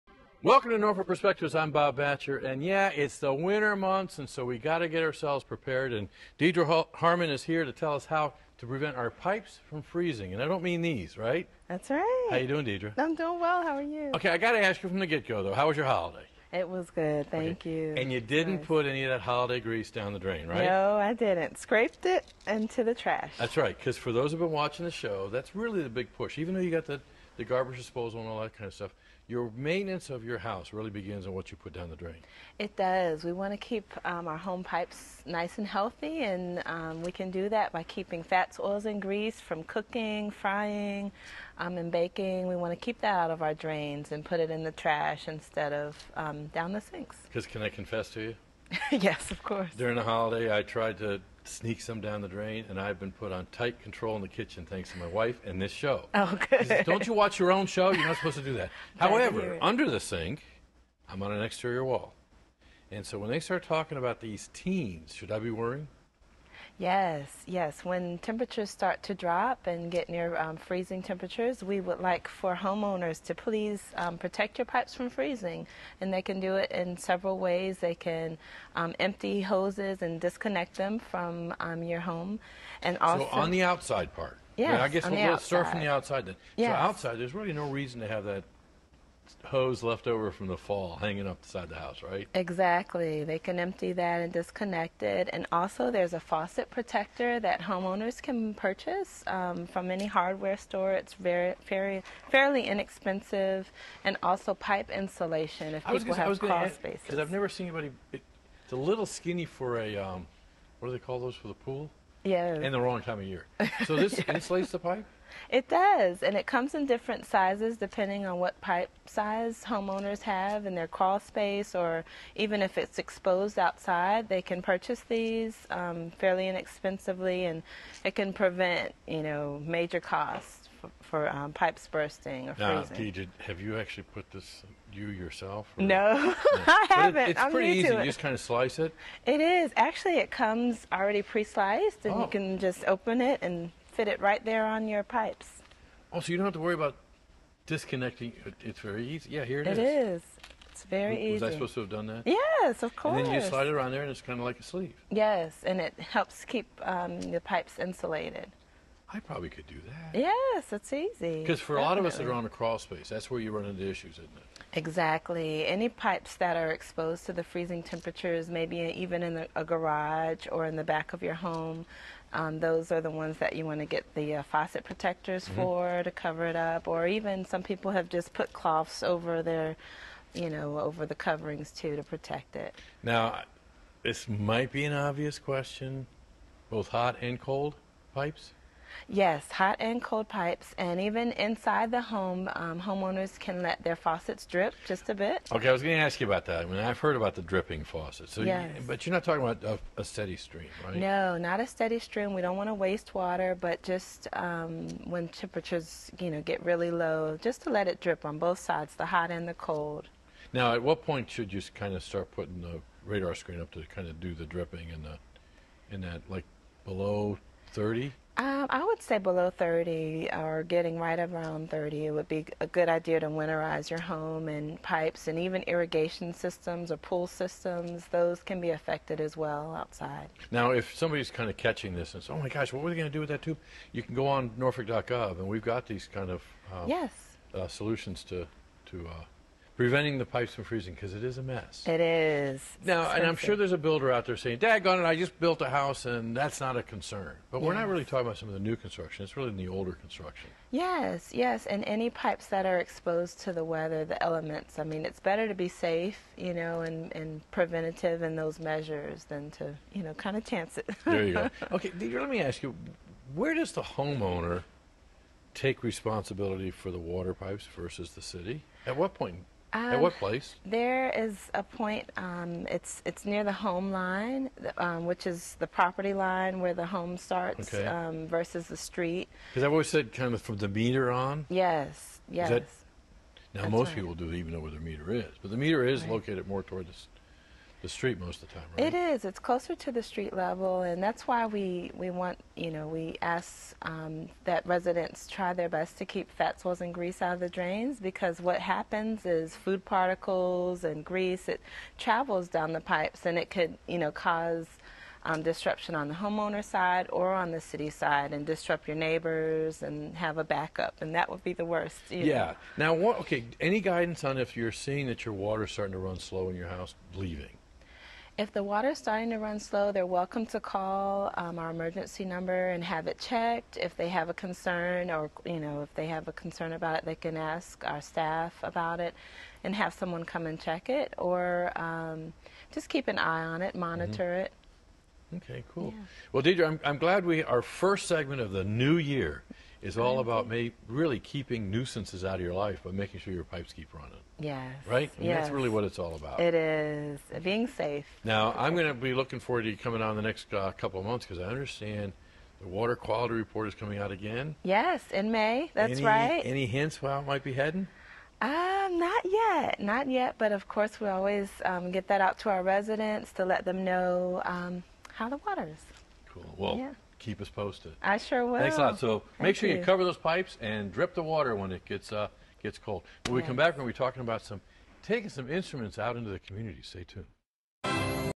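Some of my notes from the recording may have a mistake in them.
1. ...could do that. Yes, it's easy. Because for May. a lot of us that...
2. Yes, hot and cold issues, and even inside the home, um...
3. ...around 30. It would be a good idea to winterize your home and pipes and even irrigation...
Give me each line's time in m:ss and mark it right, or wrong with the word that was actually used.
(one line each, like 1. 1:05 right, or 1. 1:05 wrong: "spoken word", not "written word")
1. 2:39 wrong: "Definitely", not "May"
2. 3:09 wrong: "pipes", not "issues"
3. 3:41 right.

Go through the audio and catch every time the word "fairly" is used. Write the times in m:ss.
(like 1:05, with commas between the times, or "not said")
1:42, 2:06.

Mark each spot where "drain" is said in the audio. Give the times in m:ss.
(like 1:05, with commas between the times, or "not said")
0:20, 0:31, 0:43, 0:52, 4:57.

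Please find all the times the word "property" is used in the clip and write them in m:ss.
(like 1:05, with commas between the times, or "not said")
4:35.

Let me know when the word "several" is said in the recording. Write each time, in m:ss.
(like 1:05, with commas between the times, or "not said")
1:16.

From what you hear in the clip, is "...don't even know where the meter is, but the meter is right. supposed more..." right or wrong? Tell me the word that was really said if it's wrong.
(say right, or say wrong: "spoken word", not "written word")
wrong: "located", not "supposed".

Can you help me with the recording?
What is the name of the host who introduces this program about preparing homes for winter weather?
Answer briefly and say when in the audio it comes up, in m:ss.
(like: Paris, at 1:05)
Bob Batcher, at 0:01.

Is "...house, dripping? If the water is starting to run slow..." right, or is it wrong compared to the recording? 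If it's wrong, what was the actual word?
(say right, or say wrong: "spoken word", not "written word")
wrong: "leaving", not "dripping".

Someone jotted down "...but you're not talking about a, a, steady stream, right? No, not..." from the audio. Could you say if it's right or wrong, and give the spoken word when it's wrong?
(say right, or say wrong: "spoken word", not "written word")
right.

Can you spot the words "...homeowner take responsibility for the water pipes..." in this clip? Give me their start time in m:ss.
4:23.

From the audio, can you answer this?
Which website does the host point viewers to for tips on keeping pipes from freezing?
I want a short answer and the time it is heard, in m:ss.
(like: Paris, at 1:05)
norfolk.gov, at 3:54.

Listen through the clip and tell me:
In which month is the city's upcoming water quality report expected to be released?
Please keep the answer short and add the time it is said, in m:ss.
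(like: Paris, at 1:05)
May, at 5:55.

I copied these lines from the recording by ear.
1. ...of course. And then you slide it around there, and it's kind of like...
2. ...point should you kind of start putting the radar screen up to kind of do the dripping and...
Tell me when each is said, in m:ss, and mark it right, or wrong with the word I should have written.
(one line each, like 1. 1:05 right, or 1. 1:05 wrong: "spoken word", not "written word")
1. 2:32 right
2. 3:31 right.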